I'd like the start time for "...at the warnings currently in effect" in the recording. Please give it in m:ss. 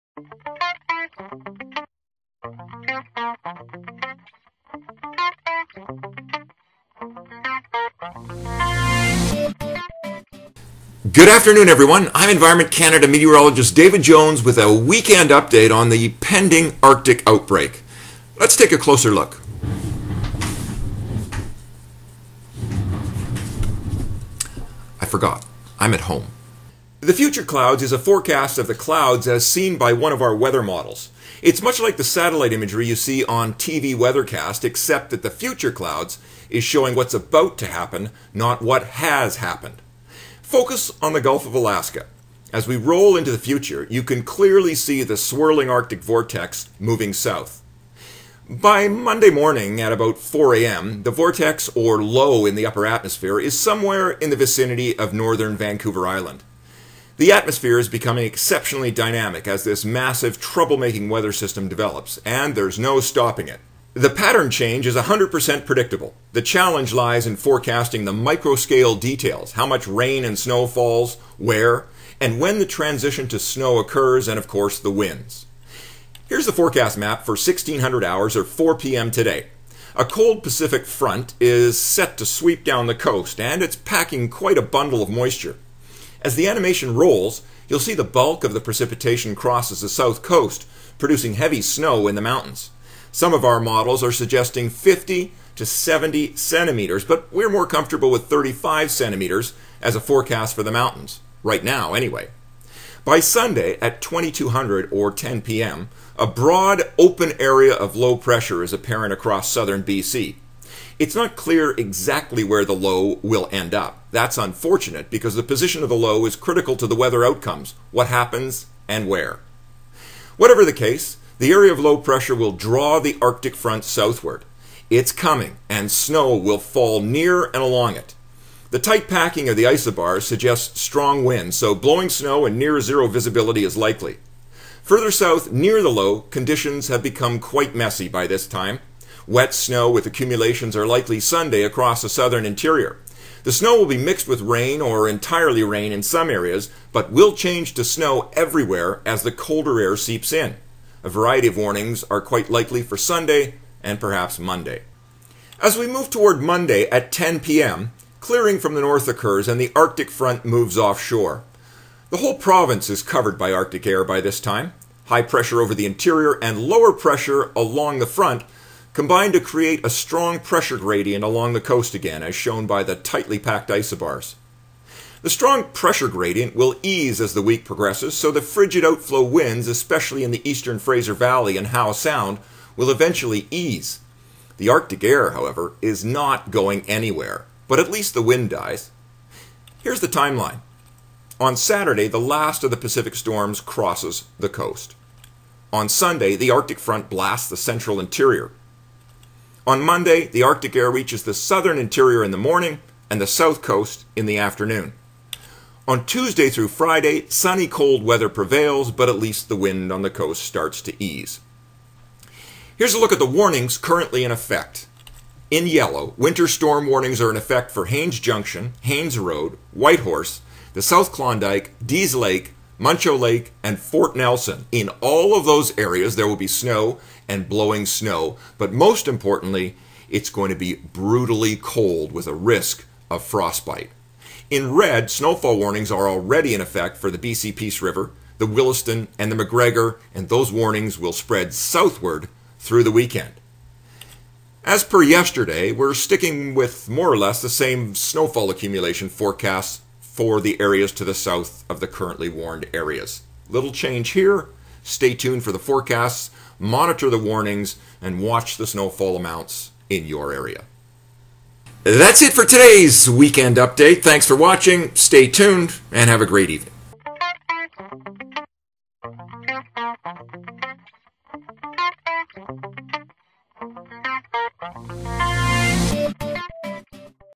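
3:33.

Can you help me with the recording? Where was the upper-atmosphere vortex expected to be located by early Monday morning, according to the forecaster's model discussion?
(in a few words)
Northern Vancouver Island.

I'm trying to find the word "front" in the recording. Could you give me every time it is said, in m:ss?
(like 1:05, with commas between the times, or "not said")
1:20, 2:03, 2:40, 2:48, 3:16.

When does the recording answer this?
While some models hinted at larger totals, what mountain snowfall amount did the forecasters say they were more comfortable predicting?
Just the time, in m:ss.
1:38.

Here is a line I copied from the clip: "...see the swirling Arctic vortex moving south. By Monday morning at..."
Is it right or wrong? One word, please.
right.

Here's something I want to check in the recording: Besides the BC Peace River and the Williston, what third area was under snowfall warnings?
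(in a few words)
McGregor.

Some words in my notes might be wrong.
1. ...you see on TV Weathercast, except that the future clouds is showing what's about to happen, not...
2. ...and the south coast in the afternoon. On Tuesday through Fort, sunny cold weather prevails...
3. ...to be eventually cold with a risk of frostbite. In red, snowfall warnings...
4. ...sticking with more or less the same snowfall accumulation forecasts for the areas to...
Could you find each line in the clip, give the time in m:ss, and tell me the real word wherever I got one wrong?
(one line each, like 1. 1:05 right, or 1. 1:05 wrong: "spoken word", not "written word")
1. 0:32 right
2. 3:23 wrong: "Friday", not "Fort"
3. 3:50 wrong: "brutally", not "eventually"
4. 4:05 right.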